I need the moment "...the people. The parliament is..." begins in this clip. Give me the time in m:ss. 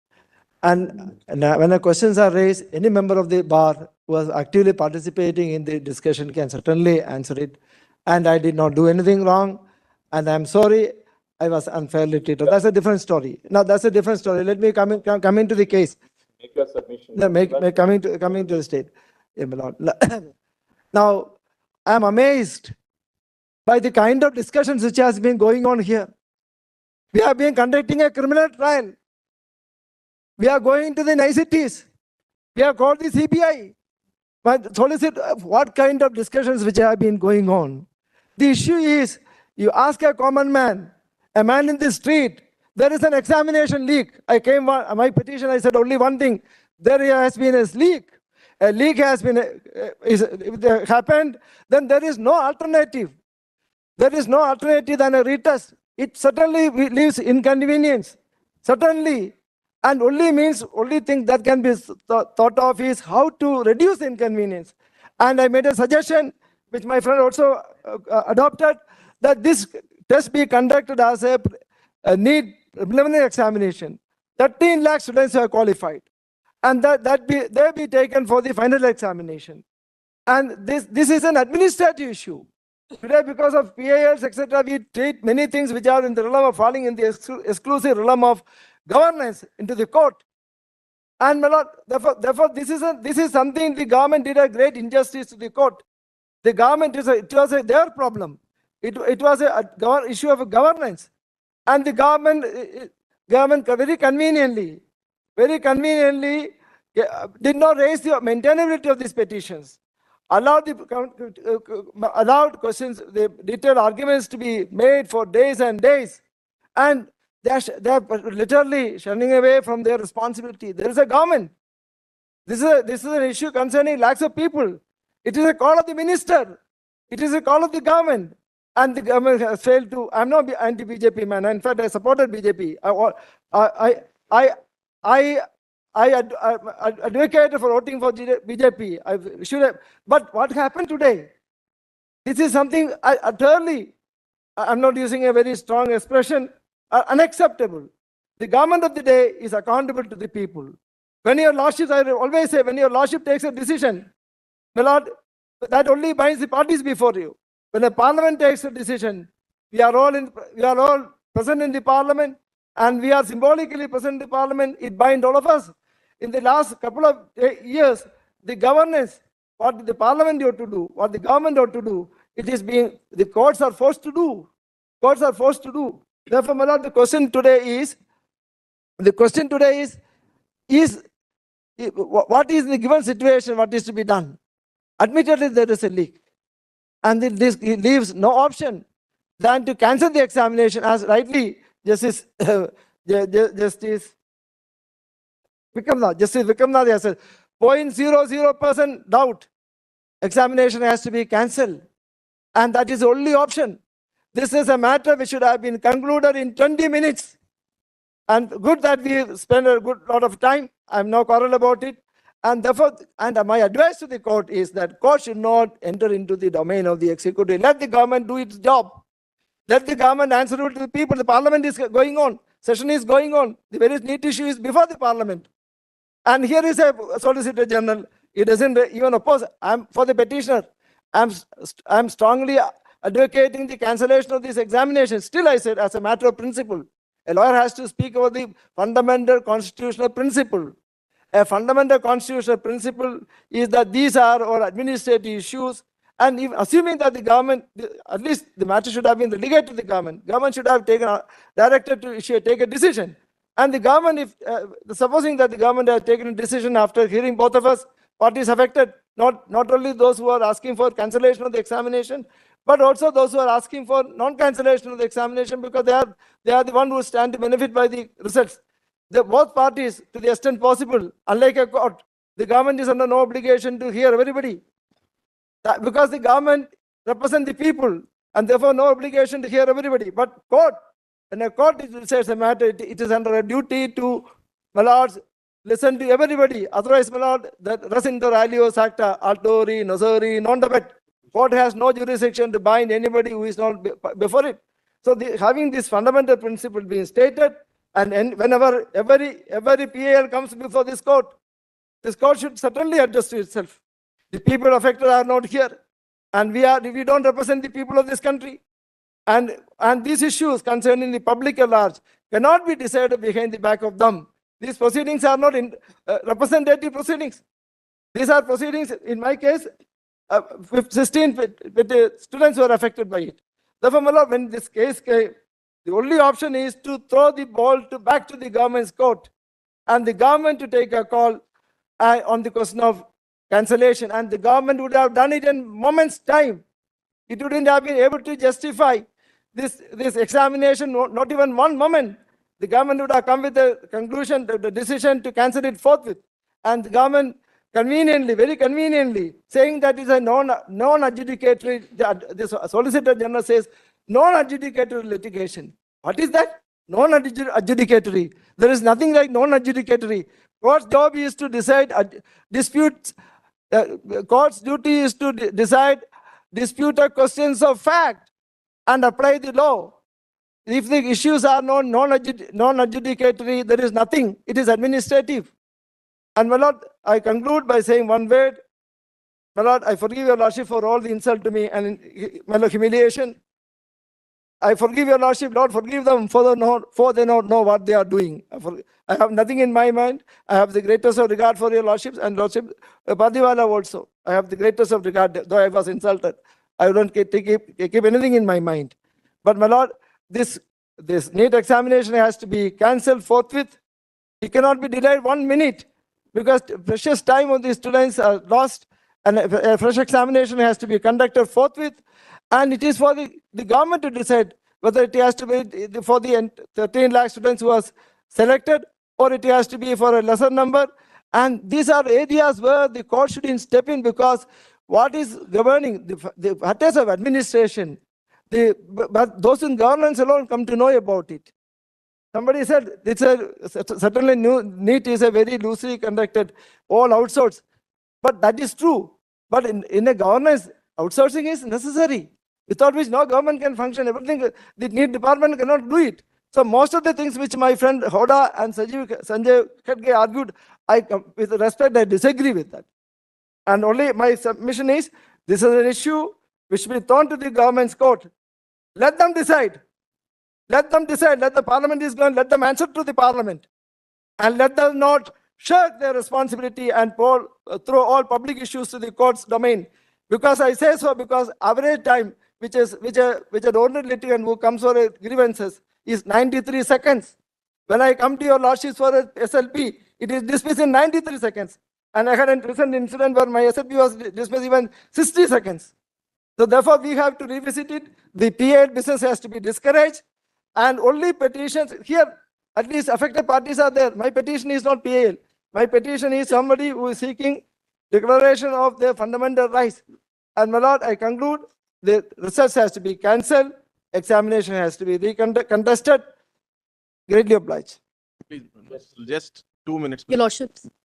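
3:40.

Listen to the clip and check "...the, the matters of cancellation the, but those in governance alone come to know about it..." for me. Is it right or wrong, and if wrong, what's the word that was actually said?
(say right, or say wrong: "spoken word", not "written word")
wrong: "administration", not "cancellation".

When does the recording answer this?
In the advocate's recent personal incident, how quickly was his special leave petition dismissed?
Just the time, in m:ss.
8:05.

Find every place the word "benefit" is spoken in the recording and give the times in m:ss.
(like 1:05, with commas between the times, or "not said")
4:27.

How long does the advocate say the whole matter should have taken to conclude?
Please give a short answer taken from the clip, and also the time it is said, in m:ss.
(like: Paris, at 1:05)
20 minutes, at 3:26.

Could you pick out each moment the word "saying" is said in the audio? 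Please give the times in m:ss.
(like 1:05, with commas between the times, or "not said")
5:49, 6:17.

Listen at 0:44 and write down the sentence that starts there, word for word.
I came uh, my petition, I said only one thing.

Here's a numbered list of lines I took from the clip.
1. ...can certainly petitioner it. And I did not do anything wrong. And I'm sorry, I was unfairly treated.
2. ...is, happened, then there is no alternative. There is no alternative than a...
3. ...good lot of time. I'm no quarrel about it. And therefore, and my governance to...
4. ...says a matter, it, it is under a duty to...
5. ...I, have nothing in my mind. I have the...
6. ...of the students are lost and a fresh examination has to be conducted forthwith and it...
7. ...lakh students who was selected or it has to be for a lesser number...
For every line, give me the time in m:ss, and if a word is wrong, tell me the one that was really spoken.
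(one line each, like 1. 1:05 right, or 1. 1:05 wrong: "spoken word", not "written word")
1. 0:06 wrong: "answer", not "petitioner"
2. 0:50 right
3. 3:29 wrong: "advice", not "governance"
4. 4:42 right
5. 6:29 right
6. 6:47 right
7. 6:57 right.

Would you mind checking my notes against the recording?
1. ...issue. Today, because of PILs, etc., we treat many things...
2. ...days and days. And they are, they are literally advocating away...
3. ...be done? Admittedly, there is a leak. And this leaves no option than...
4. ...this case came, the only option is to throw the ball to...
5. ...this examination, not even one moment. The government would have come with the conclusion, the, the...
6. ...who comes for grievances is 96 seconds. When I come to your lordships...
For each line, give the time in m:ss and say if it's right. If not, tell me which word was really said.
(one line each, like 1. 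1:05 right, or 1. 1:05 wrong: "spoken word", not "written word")
1. 1:22 right
2. 1:55 wrong: "shunning", not "advocating"
3. 3:03 right
4. 5:24 right
5. 5:39 right
6. 7:54 wrong: "93", not "96".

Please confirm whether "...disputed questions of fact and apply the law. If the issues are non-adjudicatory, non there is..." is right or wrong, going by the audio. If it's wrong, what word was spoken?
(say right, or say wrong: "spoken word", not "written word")
right.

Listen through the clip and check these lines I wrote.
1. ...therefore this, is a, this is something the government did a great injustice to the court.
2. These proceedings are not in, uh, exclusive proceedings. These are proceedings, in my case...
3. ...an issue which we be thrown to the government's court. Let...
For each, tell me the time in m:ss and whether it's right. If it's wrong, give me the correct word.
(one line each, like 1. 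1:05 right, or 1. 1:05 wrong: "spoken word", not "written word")
1. 1:32 right
2. 5:14 wrong: "representative", not "exclusive"
3. 7:35 right.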